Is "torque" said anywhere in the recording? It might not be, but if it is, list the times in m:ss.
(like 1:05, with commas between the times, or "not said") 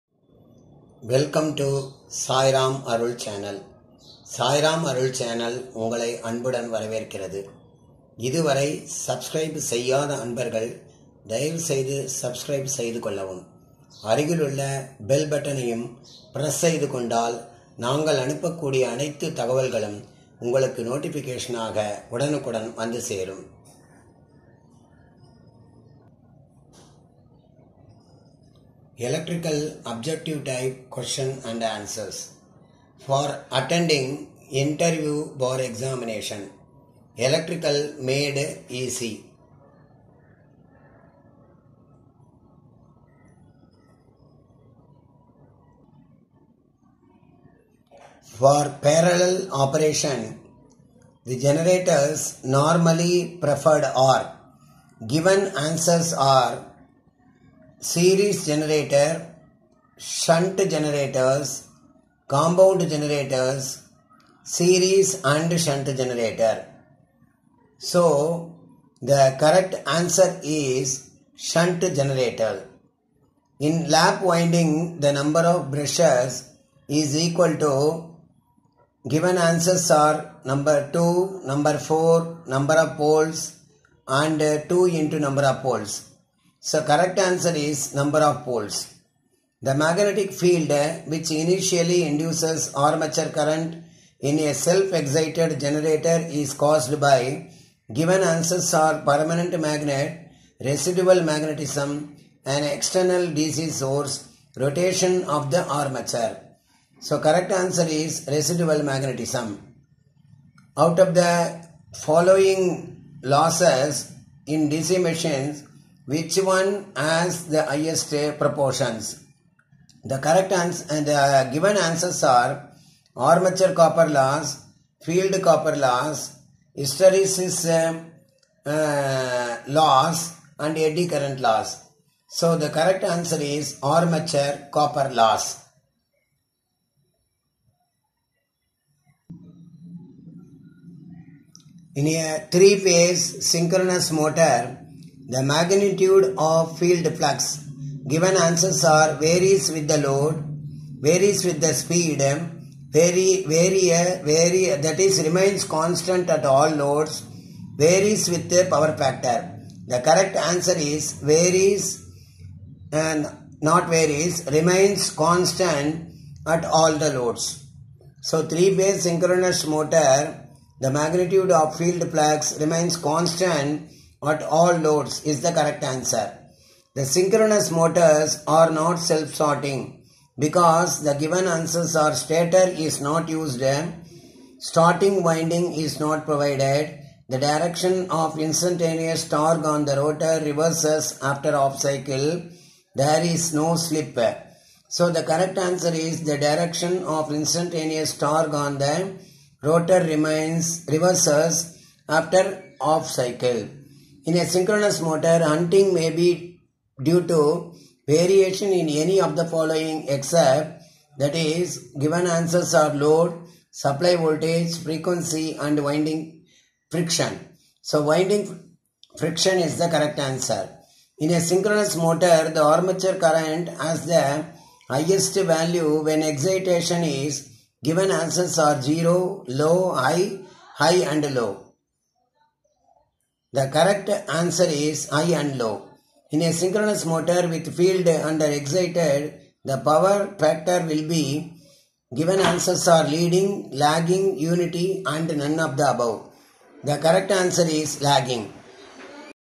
3:09, 3:18.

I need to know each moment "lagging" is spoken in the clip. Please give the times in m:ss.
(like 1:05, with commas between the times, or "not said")
4:03, 4:08.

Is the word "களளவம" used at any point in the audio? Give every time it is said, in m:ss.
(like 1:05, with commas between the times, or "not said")
0:13.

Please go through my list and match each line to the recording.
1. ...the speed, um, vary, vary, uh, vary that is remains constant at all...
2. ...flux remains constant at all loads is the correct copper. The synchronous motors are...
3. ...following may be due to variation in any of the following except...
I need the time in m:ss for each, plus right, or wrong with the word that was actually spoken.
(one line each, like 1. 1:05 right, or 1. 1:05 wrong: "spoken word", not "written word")
1. 2:31 right
2. 2:52 wrong: "answer", not "copper"
3. 3:25 wrong: "hunting", not "following".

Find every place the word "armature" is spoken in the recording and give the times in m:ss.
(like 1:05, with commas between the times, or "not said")
1:32, 1:45, 2:03, 2:13, 3:42.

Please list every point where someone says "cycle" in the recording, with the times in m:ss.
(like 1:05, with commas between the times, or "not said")
3:11, 3:23.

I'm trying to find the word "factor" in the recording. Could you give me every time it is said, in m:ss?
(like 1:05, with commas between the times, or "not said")
2:38, 4:00.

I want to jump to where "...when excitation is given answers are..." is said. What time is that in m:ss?
3:46.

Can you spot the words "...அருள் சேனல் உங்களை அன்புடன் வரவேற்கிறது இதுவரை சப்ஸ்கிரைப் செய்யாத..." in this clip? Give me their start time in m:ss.
0:04.